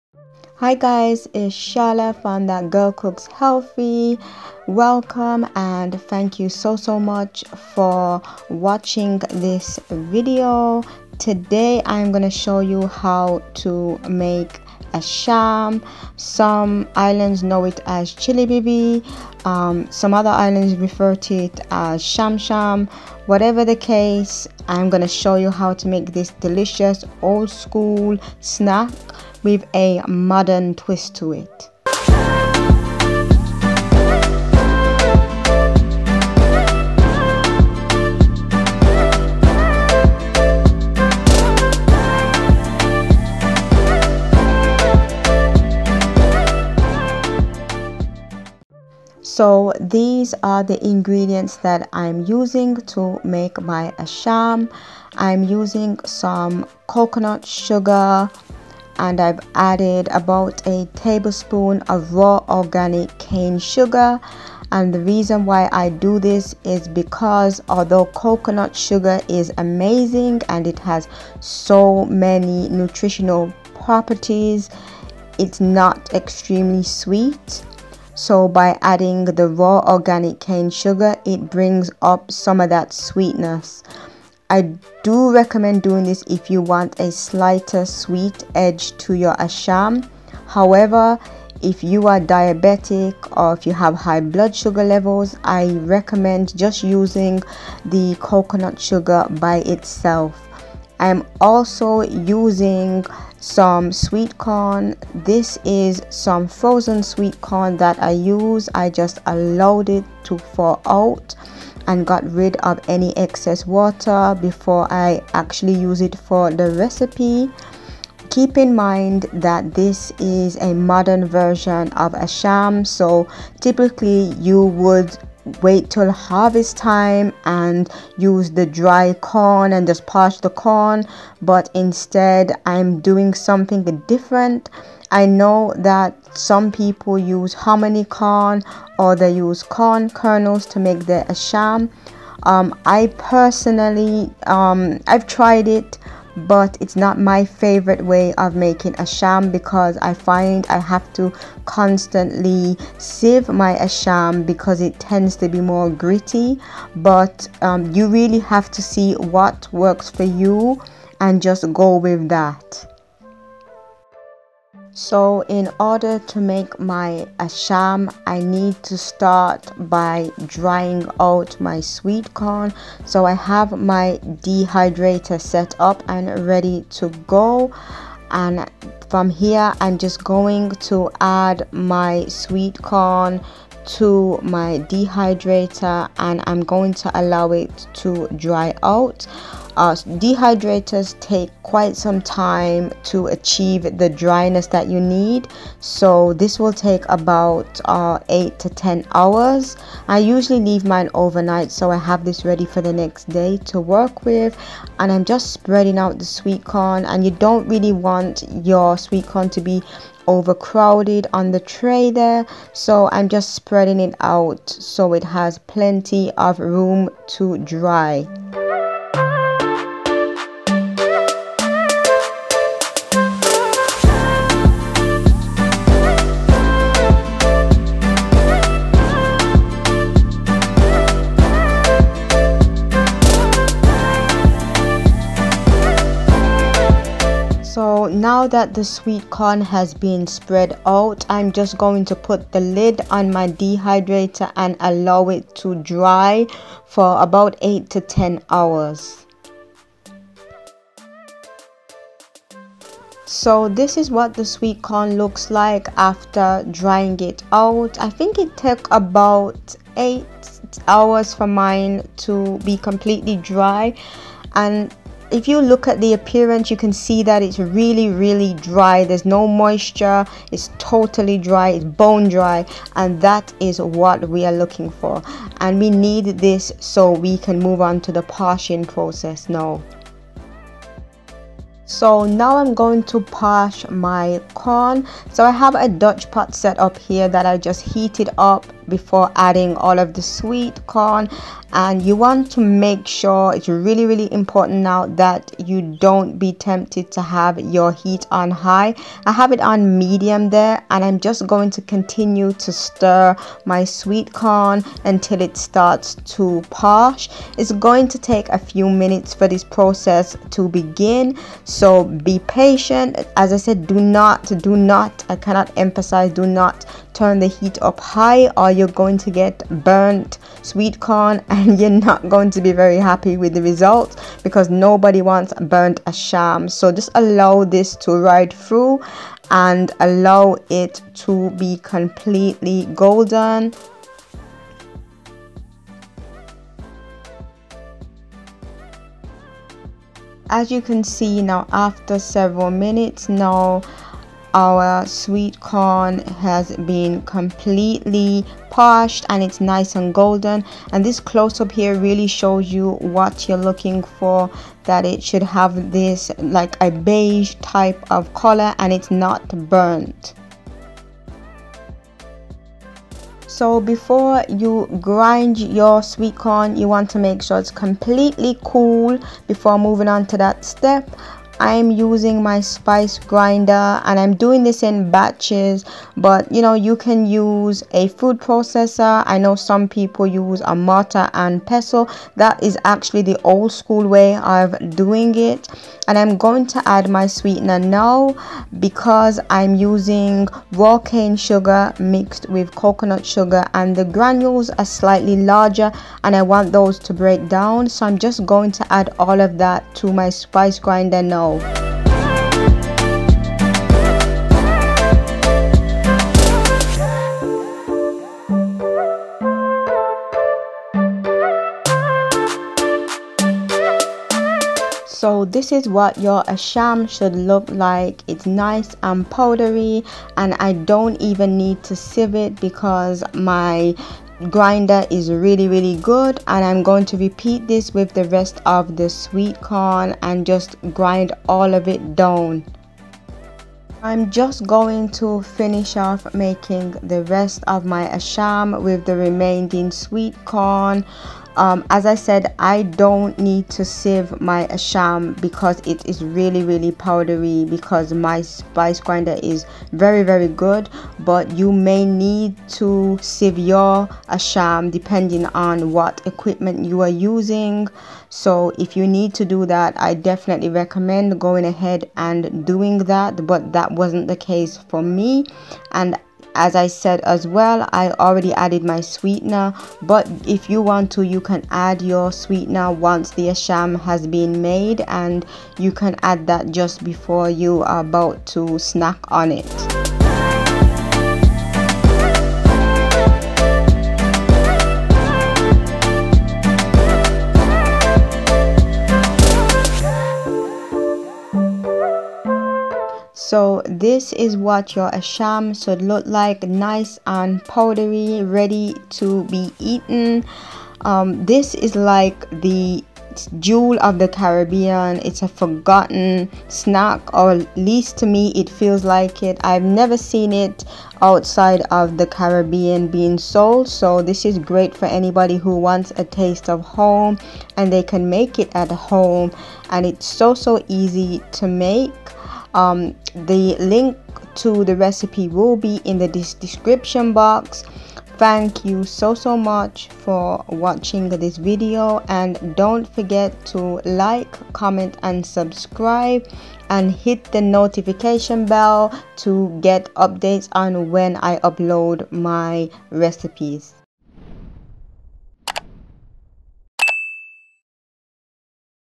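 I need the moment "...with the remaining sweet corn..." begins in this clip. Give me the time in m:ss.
7:18.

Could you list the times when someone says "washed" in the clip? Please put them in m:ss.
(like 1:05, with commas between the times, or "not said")
not said.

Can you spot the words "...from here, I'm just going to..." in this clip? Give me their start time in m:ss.
2:59.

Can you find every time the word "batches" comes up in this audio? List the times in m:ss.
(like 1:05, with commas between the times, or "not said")
6:15.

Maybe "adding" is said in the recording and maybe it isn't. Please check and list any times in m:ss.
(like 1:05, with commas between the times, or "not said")
1:18, 4:49.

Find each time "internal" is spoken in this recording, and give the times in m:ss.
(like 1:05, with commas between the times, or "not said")
not said.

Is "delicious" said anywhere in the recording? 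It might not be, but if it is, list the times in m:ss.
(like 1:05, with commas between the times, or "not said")
0:26.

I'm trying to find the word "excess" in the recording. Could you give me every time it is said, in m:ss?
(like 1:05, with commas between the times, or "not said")
1:53.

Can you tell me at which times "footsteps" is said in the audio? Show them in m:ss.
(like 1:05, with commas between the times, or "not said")
not said.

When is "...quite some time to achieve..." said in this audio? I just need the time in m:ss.
3:11.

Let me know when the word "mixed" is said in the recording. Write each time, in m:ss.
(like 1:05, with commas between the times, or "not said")
6:31.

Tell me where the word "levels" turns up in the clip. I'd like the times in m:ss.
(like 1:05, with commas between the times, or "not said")
1:34.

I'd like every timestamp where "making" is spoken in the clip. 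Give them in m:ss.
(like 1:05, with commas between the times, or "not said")
2:28, 7:16.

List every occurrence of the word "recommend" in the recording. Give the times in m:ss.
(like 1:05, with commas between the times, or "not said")
1:25, 1:35, 7:40.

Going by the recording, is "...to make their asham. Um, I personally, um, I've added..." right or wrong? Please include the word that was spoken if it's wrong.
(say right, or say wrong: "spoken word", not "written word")
wrong: "tried", not "added".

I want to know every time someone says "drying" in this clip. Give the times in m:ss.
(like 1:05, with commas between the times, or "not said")
2:50, 4:16.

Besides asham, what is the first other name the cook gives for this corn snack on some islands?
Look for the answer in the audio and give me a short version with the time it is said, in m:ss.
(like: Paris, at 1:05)
chilibibi, at 0:18.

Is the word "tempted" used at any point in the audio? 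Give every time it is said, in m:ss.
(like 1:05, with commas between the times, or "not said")
4:56.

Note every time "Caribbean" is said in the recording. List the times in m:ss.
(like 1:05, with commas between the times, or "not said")
8:24, 8:32.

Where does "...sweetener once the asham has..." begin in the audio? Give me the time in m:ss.
7:52.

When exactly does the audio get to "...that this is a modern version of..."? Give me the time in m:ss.
1:59.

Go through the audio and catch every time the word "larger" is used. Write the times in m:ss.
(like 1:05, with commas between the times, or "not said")
6:35.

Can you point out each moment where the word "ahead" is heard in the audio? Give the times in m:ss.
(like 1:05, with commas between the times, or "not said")
7:41.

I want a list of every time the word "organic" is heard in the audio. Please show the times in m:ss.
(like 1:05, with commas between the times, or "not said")
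1:02, 1:19.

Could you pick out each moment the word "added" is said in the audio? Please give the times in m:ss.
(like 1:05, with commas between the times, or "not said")
0:59, 7:48.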